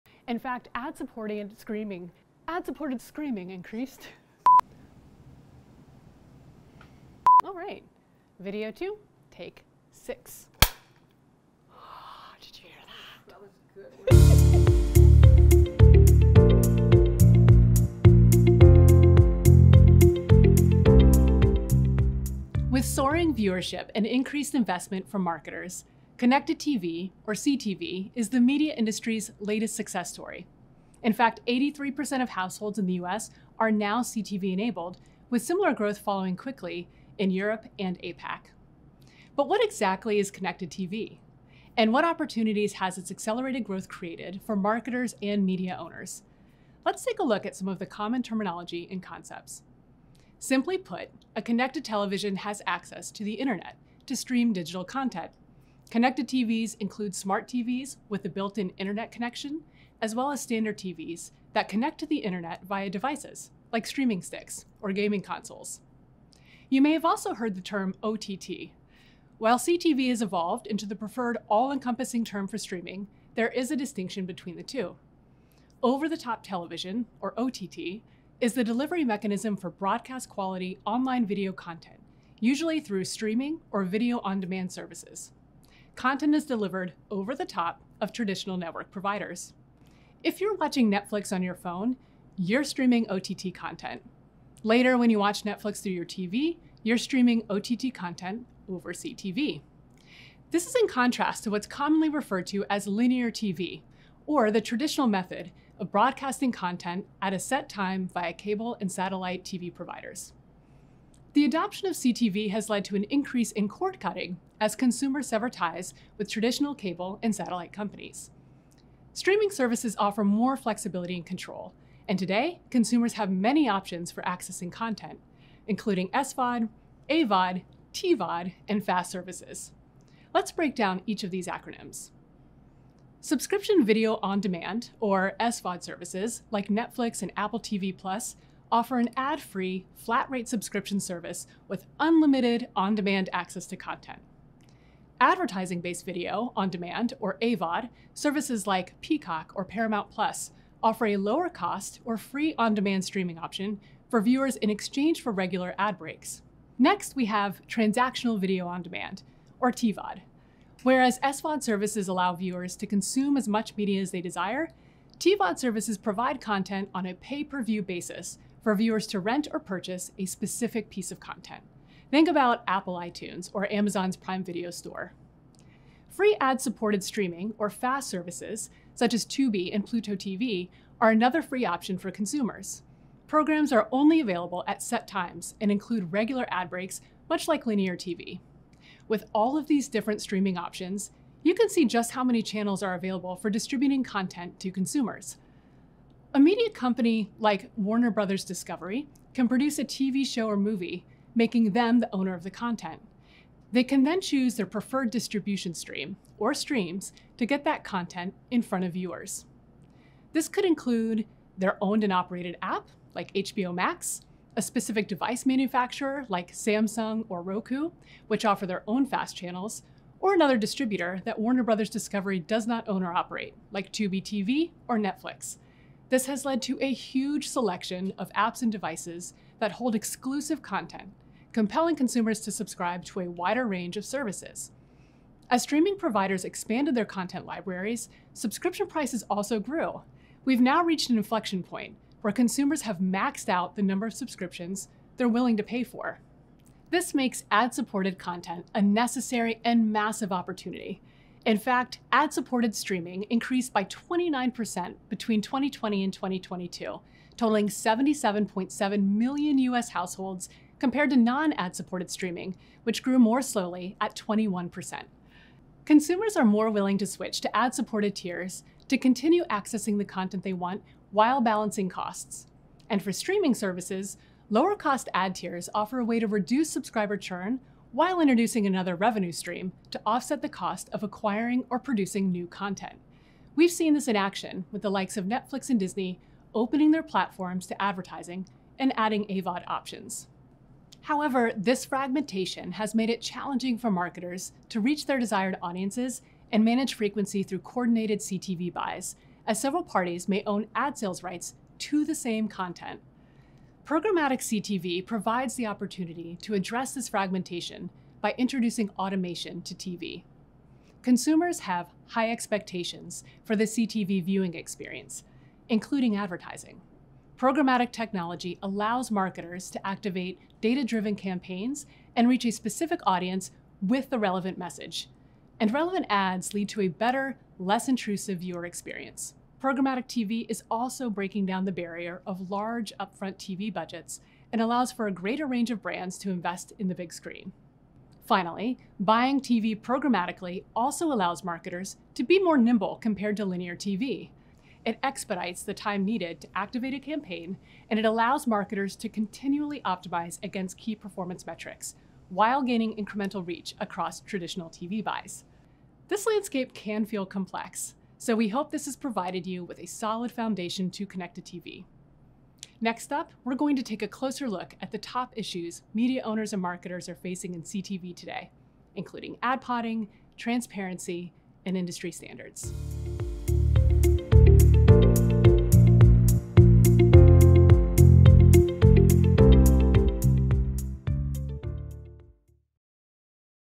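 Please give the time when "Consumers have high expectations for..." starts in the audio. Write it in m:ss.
5:11.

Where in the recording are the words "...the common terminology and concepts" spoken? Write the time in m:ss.
0:47.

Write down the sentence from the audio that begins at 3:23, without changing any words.
They can then choose their preferred distribution stream, or streams, to get that content in front of viewers.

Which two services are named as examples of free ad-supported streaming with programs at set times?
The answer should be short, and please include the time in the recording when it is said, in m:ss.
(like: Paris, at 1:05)
Tubi and Pluto TV, at 2:59.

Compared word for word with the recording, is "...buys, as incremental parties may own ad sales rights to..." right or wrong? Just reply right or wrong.
wrong.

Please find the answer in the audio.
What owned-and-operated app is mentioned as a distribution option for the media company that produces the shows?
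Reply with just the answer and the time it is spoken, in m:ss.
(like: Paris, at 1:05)
HBO Max, at 3:33.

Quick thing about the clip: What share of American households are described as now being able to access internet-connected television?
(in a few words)
83%.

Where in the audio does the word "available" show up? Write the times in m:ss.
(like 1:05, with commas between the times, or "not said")
3:04, 3:12.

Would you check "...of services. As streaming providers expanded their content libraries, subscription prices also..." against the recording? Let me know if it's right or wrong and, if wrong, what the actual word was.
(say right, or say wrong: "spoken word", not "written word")
right.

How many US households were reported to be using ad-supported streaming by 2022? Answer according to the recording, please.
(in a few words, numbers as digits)
77.7 million.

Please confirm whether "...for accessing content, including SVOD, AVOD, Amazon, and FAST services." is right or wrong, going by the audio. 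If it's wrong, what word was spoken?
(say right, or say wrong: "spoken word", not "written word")
wrong: "TVOD", not "Amazon".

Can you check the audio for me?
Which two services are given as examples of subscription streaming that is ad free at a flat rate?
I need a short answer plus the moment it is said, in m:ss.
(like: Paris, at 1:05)
Netflix and Apple TV Plus, at 2:16.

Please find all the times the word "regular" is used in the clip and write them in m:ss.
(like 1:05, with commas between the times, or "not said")
2:35, 3:06.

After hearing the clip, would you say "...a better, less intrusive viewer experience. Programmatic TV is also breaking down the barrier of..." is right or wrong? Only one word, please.
right.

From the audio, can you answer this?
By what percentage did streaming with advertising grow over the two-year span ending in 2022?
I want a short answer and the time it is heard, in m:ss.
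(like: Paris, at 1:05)
29%, at 4:13.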